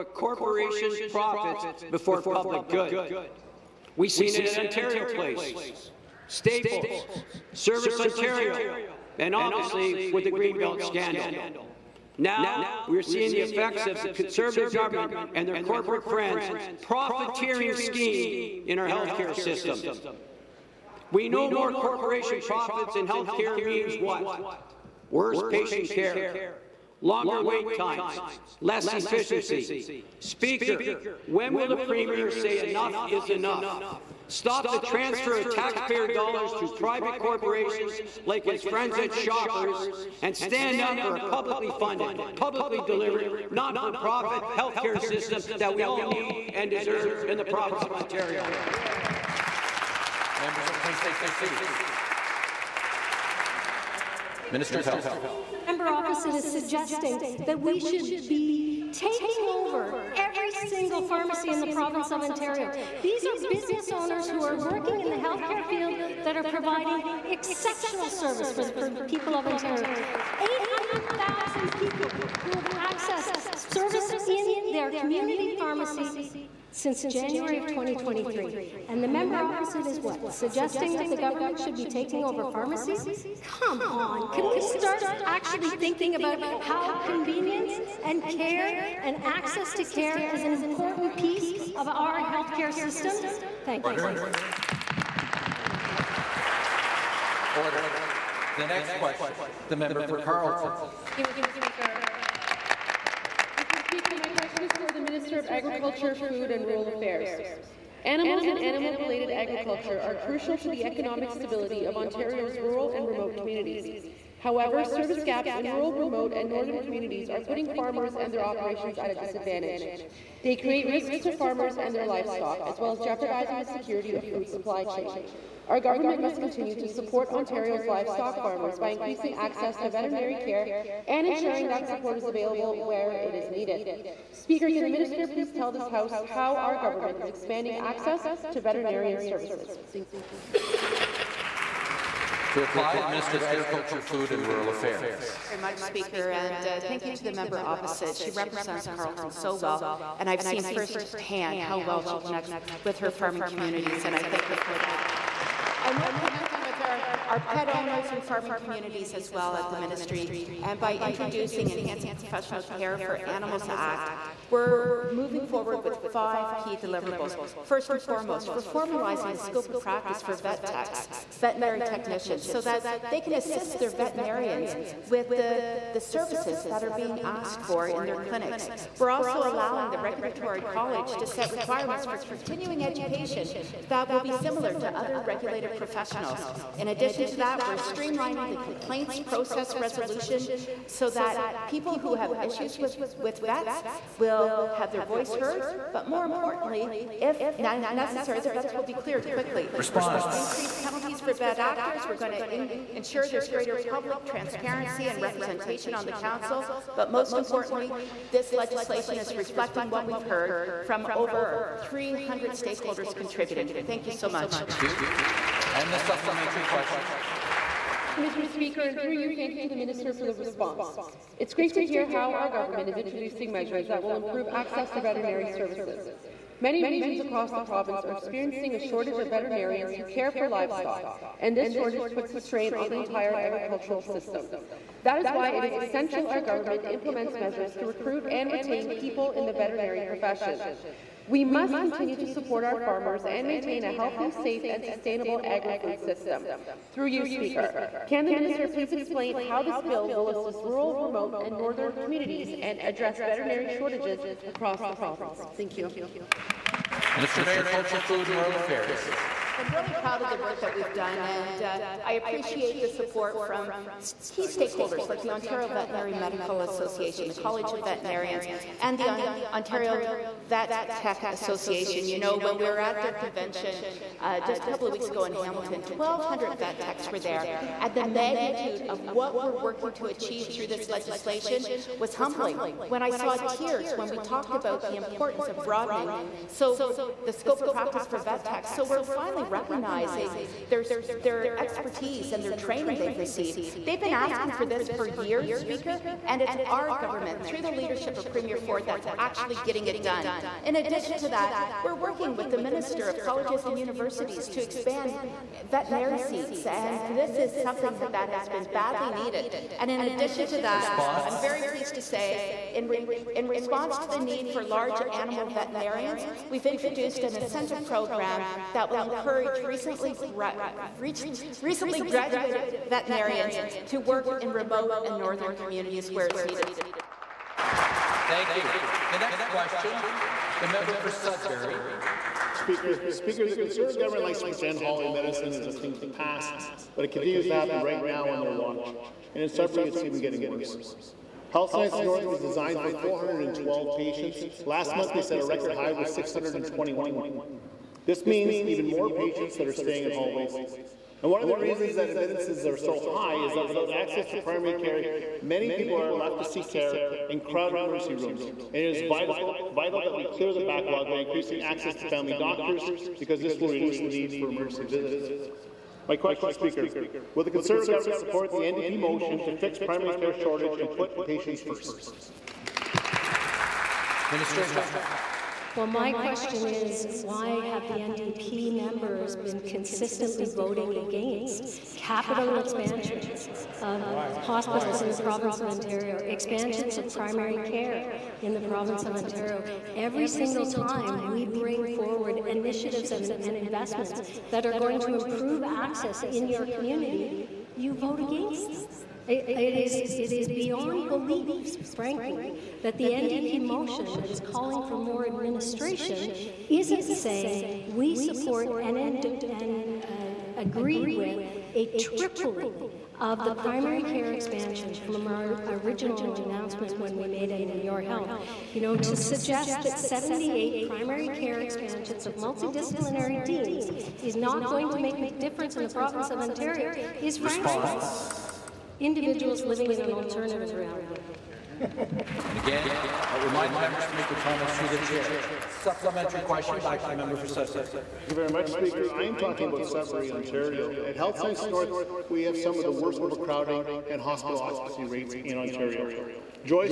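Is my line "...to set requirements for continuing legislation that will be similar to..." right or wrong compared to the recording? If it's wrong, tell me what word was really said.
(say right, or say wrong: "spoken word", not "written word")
wrong: "education", not "legislation".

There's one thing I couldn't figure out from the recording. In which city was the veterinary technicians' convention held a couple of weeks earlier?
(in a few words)
Hamilton.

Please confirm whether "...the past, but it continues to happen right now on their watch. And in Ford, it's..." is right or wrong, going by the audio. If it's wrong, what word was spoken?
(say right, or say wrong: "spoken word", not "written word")
wrong: "Sudbury", not "Ford".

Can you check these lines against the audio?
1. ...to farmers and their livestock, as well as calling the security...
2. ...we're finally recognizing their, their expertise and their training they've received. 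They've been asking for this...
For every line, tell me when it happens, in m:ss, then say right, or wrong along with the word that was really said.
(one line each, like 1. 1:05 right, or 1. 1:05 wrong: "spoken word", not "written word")
1. 2:01 wrong: "jeopardizing", not "calling"
2. 4:48 right.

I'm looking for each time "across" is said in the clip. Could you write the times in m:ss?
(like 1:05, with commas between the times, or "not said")
3:47, 4:14.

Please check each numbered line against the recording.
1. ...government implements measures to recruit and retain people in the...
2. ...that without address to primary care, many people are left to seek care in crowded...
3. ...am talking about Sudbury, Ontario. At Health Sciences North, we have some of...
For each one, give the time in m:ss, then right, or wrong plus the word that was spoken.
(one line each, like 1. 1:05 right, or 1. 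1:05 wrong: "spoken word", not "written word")
1. 3:56 right
2. 5:53 wrong: "access", not "address"
3. 7:19 right.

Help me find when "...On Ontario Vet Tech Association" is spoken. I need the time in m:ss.
4:29.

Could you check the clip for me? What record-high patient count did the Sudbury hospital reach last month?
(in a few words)
621.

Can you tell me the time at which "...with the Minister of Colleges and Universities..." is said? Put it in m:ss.
5:02.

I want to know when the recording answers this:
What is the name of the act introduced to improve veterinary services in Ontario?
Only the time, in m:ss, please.
2:41.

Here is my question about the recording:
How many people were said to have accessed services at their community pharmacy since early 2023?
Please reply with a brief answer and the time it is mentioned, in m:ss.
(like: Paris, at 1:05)
800,000, at 1:10.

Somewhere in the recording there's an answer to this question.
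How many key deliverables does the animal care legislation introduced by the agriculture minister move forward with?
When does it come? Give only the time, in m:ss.
2:46.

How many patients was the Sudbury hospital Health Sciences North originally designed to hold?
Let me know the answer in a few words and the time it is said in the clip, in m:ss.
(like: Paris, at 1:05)
412, at 5:42.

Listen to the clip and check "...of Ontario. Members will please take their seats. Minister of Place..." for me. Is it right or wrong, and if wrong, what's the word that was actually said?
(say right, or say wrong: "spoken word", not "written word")
wrong: "Health", not "Place".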